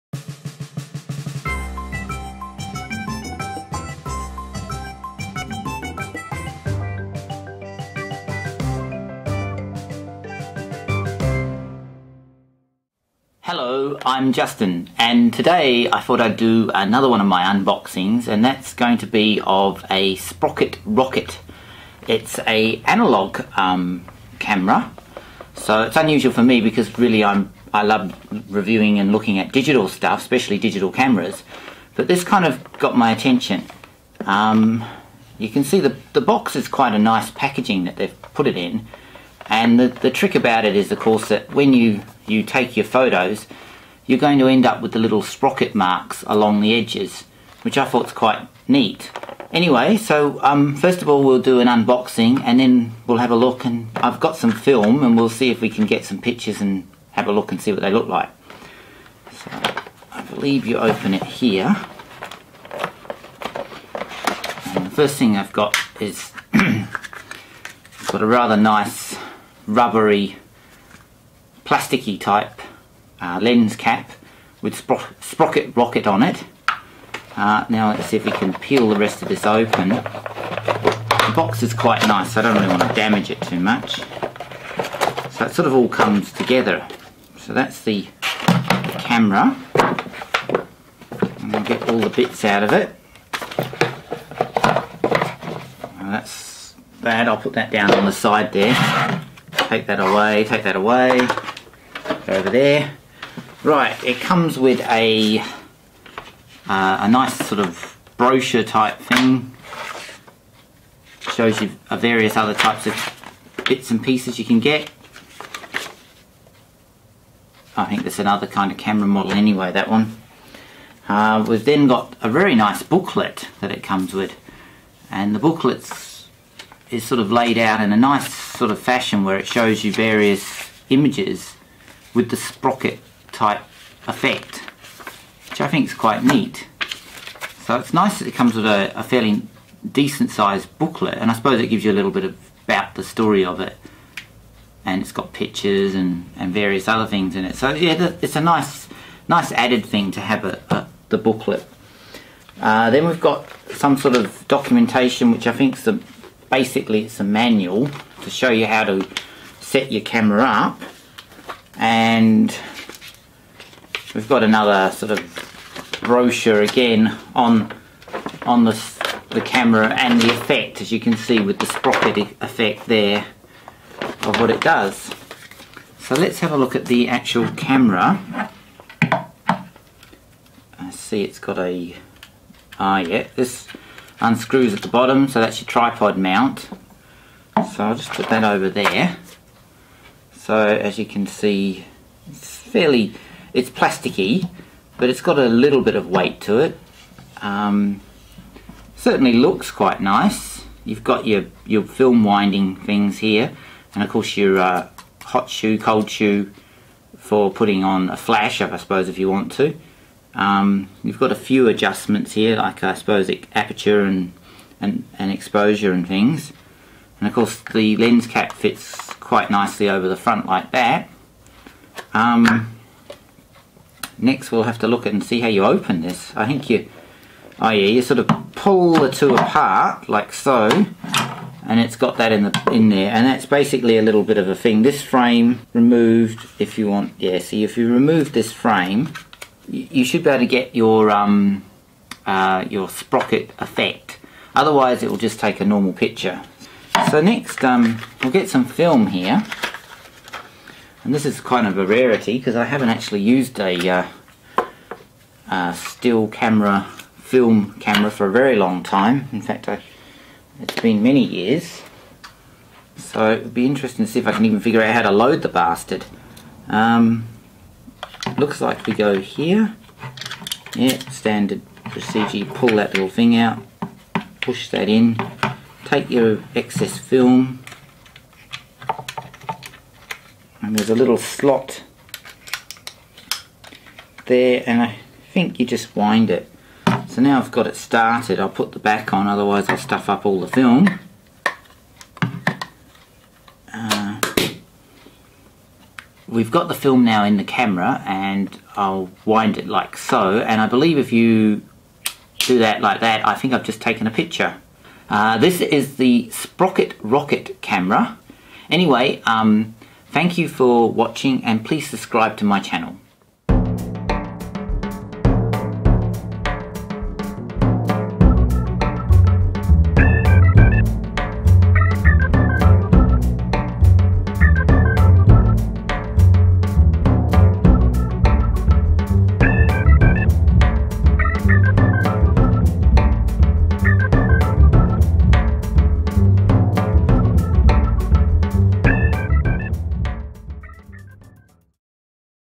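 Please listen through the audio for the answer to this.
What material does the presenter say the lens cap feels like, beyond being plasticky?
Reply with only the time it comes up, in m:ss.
1:09.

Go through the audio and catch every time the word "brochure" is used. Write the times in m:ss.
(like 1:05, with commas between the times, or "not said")
1:48, 2:46.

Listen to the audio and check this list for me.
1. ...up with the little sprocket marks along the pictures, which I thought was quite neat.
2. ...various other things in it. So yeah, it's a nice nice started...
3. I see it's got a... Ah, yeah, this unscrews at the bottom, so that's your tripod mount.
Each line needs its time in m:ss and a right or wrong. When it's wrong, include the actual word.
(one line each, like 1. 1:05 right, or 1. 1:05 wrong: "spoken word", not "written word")
1. 0:44 wrong: "edges", not "pictures"
2. 2:26 wrong: "added", not "started"
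3. 2:59 right.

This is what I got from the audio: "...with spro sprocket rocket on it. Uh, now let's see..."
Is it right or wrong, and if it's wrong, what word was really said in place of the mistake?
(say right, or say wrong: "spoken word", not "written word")
right.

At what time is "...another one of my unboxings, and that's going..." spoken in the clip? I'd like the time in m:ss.
0:16.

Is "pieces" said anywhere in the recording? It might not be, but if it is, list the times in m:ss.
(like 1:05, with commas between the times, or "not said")
1:54.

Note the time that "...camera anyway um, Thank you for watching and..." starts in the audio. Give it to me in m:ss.
5:07.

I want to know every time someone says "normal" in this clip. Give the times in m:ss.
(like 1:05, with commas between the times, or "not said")
4:05.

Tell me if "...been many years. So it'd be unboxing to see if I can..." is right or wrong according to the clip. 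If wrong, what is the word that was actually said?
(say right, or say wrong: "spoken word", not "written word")
wrong: "interesting", not "unboxing".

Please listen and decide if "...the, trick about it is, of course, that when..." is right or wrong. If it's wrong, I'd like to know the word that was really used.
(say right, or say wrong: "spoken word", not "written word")
right.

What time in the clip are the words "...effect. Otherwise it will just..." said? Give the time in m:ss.
4:03.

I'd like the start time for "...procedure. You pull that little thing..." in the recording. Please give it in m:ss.
4:31.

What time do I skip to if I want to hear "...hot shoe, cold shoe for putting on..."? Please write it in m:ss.
3:25.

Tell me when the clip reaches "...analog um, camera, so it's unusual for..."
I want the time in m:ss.
0:22.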